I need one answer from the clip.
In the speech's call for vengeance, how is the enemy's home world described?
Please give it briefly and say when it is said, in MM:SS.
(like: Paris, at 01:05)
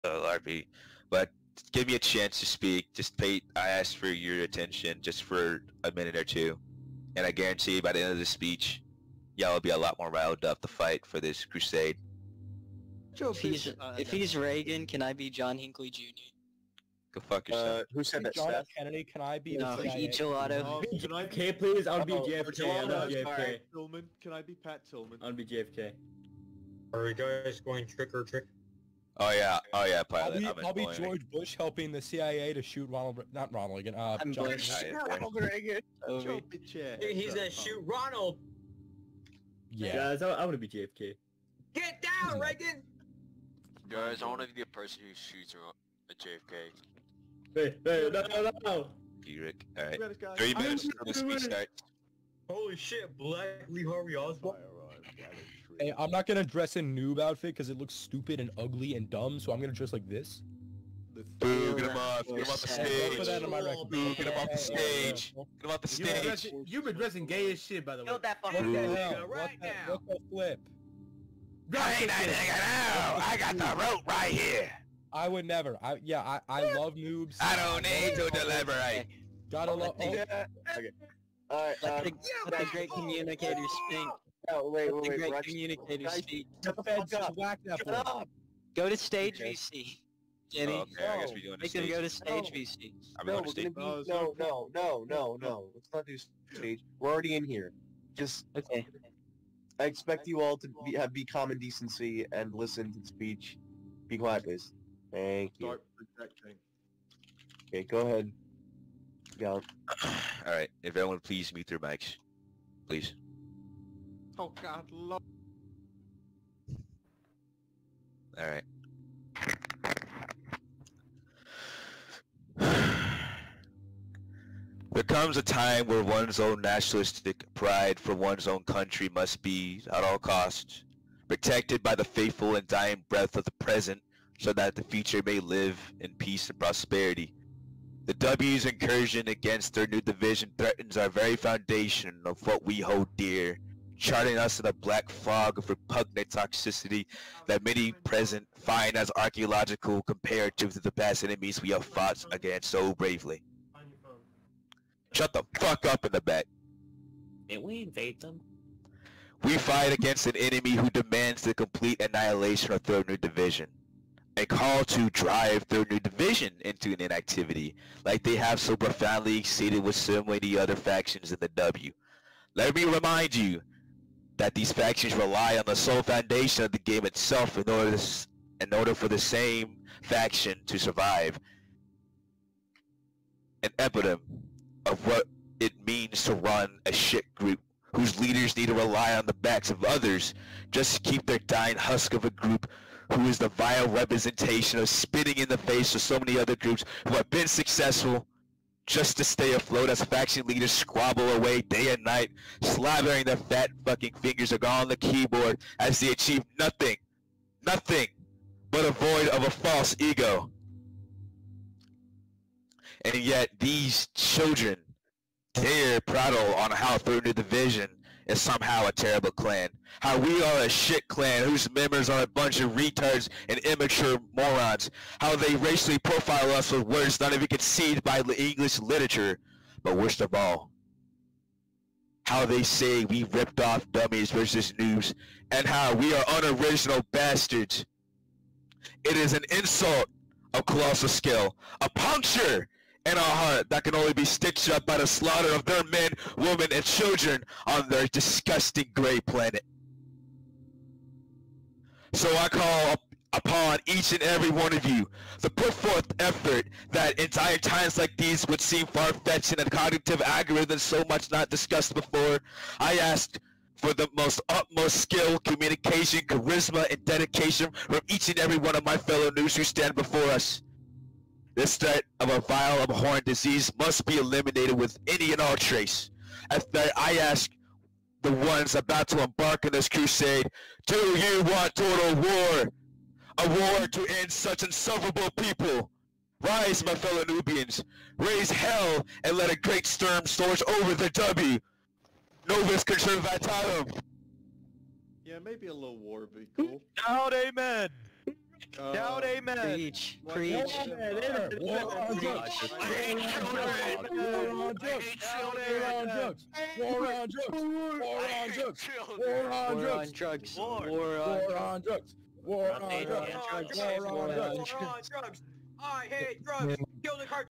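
disgusting gray planet, at 04:08.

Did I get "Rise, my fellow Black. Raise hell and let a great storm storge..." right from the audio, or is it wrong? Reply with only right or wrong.
wrong.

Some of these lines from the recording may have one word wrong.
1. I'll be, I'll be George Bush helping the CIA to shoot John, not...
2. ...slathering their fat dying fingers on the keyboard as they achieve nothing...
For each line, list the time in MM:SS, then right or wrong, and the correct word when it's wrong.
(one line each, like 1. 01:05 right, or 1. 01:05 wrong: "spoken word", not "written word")
1. 00:30 wrong: "Ronald", not "John"
2. 03:22 wrong: "fucking", not "dying".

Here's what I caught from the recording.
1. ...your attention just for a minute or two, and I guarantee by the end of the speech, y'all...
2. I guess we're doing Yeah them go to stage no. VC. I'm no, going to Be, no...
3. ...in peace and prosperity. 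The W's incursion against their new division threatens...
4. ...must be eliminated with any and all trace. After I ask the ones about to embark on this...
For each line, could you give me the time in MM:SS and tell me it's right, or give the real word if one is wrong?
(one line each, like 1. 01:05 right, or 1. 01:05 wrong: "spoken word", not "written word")
1. 00:04 right
2. 01:31 wrong: "Make", not "Yeah"
3. 02:16 right
4. 04:33 right.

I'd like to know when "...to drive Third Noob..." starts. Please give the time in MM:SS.
02:44.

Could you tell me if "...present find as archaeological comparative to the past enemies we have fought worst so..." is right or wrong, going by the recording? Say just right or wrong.
wrong.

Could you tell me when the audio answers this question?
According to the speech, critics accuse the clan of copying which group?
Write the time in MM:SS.
03:53.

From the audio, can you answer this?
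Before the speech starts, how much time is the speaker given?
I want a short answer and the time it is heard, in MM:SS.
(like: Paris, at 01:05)
3 minutes, at 00:50.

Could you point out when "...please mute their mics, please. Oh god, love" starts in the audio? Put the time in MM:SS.
01:51.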